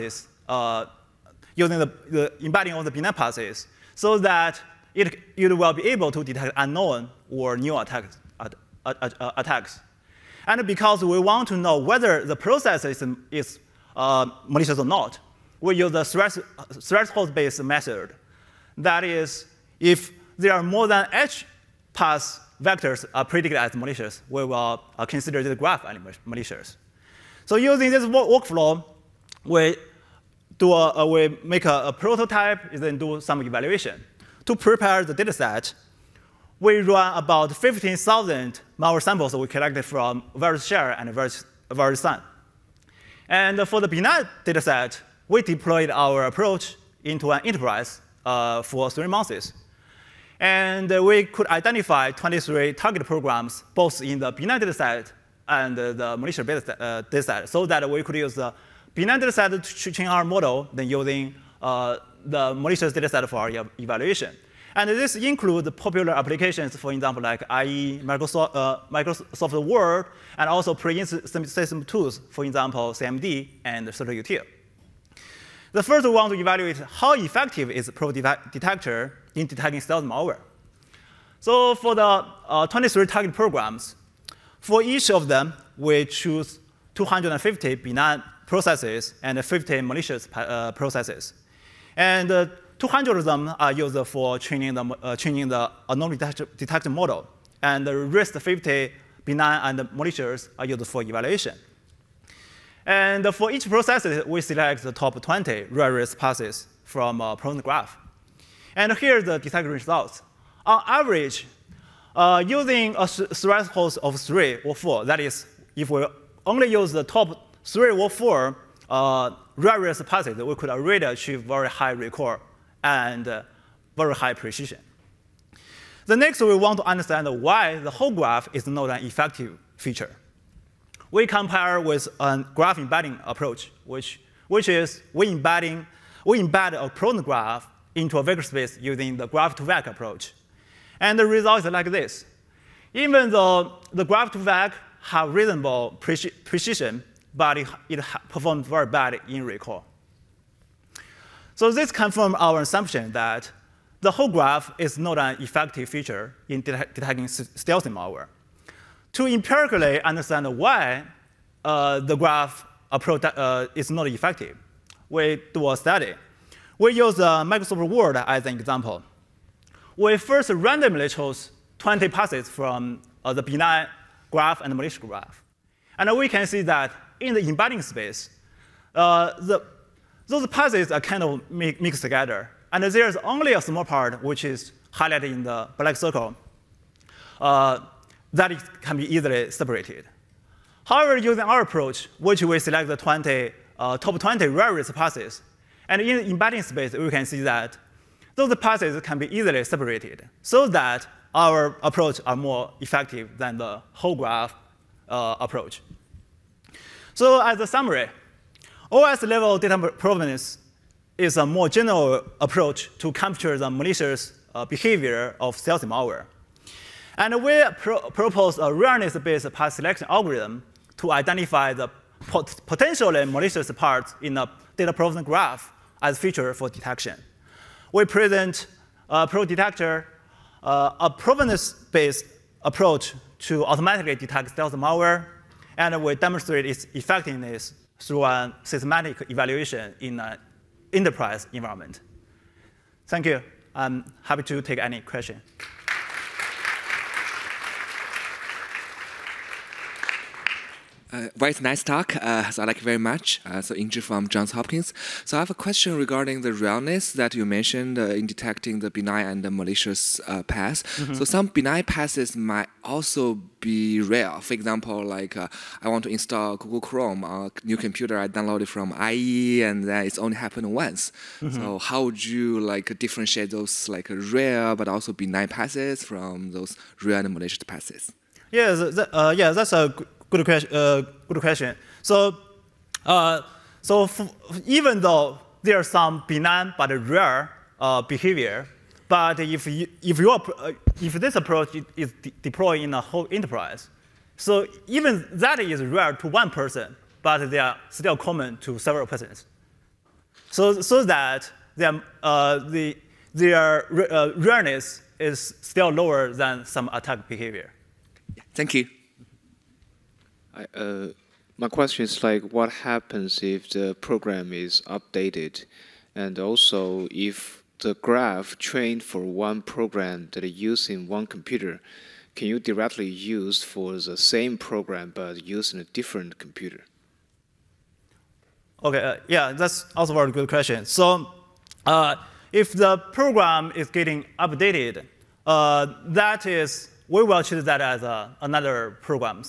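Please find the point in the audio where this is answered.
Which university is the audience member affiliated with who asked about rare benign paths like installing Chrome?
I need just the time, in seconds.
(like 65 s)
254 s.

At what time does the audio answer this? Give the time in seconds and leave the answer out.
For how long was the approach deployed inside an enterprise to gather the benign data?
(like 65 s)
48 s.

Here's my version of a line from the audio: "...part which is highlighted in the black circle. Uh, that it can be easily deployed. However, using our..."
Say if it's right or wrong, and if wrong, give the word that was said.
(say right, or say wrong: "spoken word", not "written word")
wrong: "separated", not "deployed".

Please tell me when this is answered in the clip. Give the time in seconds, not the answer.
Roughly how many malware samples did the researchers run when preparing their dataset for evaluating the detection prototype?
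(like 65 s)
37 s.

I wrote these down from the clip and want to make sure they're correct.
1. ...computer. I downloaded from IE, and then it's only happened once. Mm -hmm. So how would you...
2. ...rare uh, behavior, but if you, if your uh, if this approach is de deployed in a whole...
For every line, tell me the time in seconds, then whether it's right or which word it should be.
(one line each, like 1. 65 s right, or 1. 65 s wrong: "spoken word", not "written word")
1. 267 s right
2. 287 s right.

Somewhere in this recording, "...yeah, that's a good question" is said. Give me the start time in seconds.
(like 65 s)
279 s.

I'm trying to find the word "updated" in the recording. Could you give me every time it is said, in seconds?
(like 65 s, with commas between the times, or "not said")
314 s, 334 s.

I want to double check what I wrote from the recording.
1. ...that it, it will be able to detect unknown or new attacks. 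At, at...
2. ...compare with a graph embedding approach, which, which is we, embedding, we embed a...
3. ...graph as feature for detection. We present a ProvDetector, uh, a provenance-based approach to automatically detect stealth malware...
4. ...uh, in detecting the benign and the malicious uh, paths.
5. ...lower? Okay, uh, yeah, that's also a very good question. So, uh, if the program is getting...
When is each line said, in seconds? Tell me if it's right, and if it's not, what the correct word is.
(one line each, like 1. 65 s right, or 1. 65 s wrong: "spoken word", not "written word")
1. 4 s right
2. 131 s right
3. 225 s right
4. 257 s right
5. 326 s wrong: "computer", not "lower".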